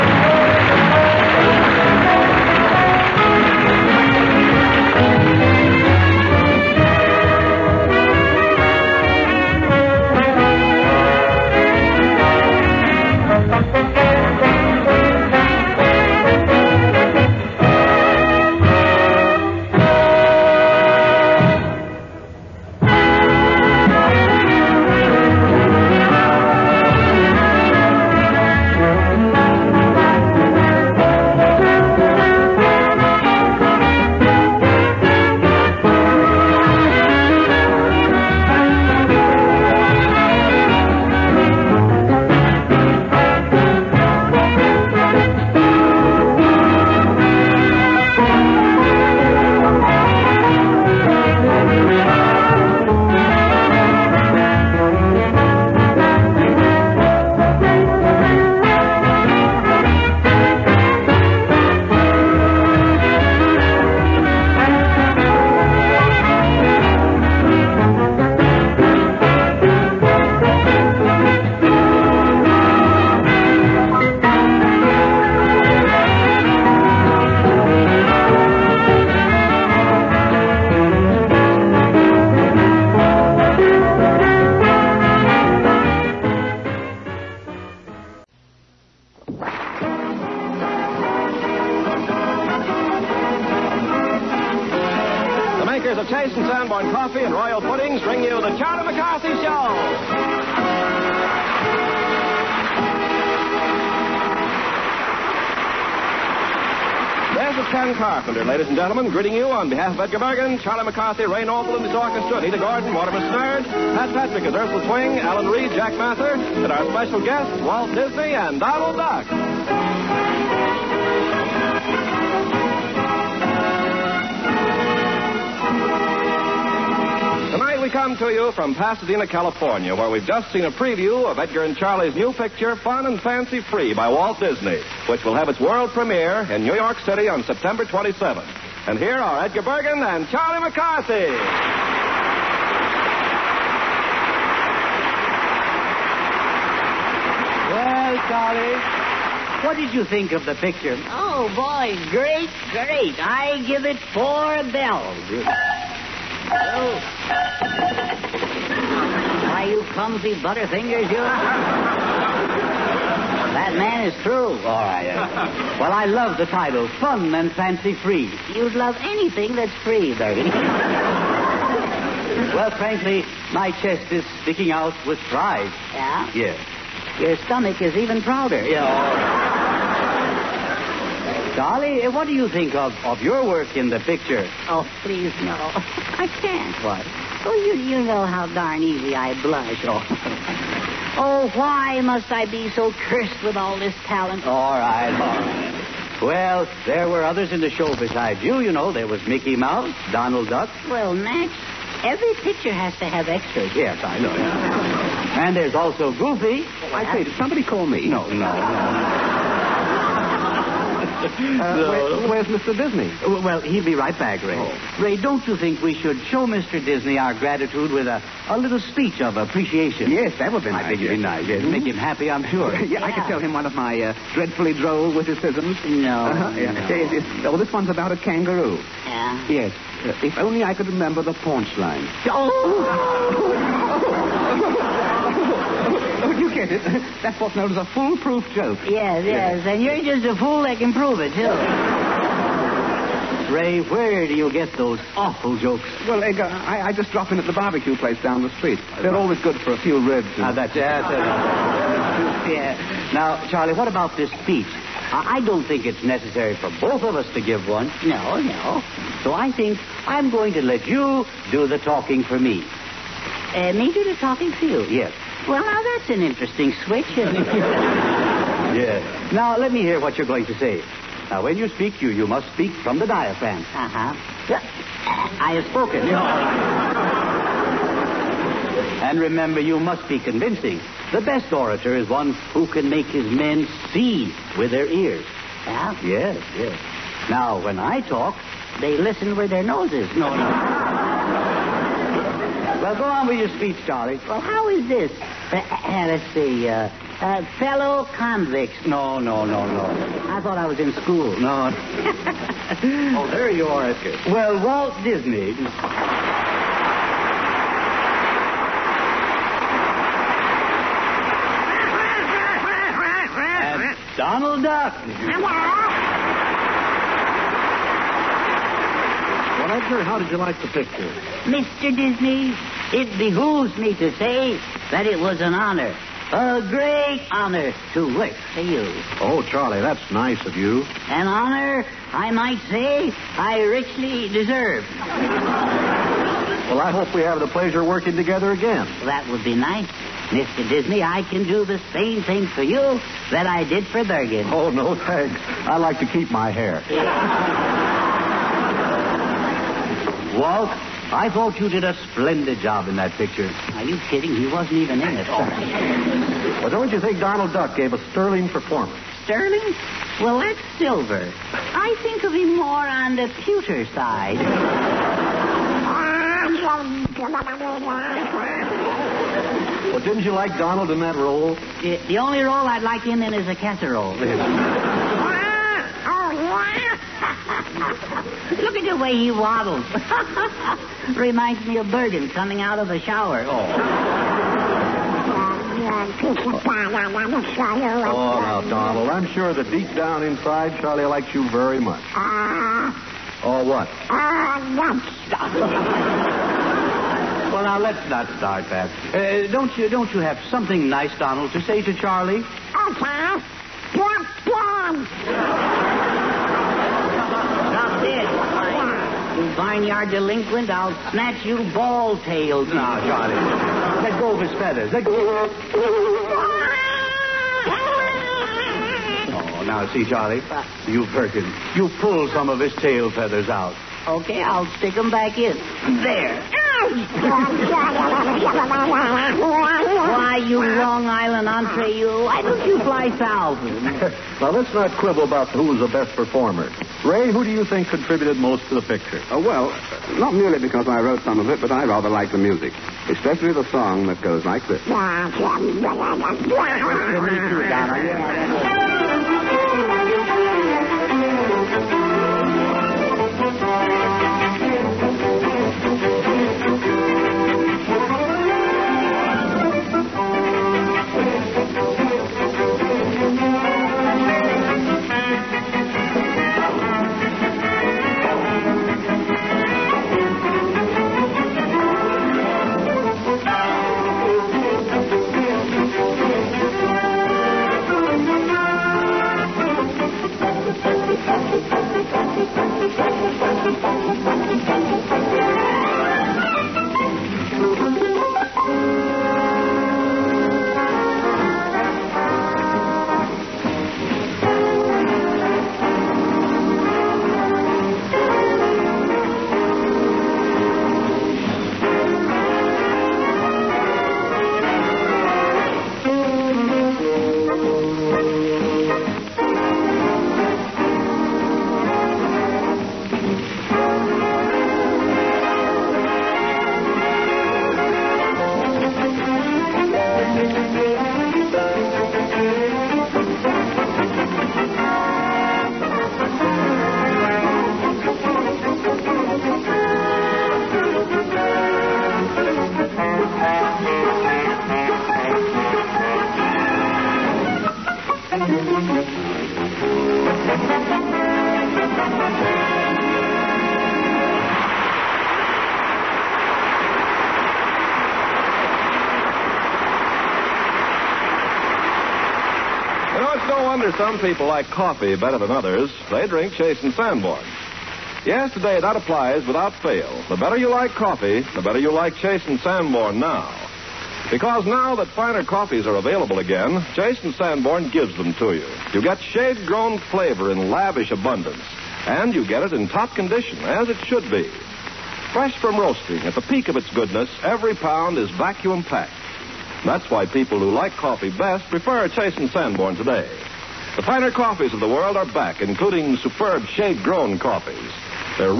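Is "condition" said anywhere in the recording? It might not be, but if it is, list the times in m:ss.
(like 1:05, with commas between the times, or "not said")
9:33.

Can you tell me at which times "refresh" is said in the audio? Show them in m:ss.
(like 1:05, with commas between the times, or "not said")
not said.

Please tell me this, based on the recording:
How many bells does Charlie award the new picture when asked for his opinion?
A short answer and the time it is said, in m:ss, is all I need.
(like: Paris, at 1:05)
4, at 2:34.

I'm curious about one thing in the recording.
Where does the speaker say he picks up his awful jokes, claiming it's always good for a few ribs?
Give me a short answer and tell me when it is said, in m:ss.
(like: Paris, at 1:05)
barbecue place, at 4:07.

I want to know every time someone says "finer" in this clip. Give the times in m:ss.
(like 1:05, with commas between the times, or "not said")
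9:25, 9:44.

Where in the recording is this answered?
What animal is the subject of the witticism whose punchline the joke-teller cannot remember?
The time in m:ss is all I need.
3:48.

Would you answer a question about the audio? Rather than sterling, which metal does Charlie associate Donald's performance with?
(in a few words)
pewter.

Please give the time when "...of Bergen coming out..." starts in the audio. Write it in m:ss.
6:21.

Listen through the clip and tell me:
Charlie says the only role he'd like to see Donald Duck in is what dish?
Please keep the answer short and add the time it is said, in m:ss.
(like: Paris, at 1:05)
casserole, at 6:13.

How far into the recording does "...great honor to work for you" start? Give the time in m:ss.
5:26.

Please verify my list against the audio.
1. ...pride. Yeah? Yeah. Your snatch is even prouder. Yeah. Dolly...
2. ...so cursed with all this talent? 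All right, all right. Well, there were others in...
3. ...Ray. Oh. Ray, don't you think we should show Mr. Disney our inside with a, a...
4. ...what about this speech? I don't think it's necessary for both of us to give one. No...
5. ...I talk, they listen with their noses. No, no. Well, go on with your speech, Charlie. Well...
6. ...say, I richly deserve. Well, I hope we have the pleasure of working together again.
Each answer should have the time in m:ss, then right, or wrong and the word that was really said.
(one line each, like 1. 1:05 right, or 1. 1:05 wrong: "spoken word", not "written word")
1. 2:55 wrong: "stomach", not "snatch"
2. 3:12 right
3. 3:34 wrong: "gratitude", not "inside"
4. 4:13 right
5. 4:47 right
6. 5:32 right.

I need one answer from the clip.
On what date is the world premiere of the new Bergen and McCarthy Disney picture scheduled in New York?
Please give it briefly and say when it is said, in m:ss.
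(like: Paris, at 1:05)
September 27th, at 2:17.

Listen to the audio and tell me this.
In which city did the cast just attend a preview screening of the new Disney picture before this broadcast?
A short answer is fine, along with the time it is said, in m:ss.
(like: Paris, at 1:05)
Pasadena, at 2:08.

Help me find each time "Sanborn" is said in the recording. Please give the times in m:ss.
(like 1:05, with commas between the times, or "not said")
9:16, 9:22, 9:27, 9:42.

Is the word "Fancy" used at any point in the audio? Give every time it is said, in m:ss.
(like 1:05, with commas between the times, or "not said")
2:13, 2:47.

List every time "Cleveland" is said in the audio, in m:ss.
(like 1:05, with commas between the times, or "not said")
not said.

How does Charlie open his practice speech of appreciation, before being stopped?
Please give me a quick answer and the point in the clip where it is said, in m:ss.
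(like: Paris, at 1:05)
Fellow convicts, at 4:57.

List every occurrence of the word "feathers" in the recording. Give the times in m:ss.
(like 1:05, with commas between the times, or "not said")
6:54, 7:03.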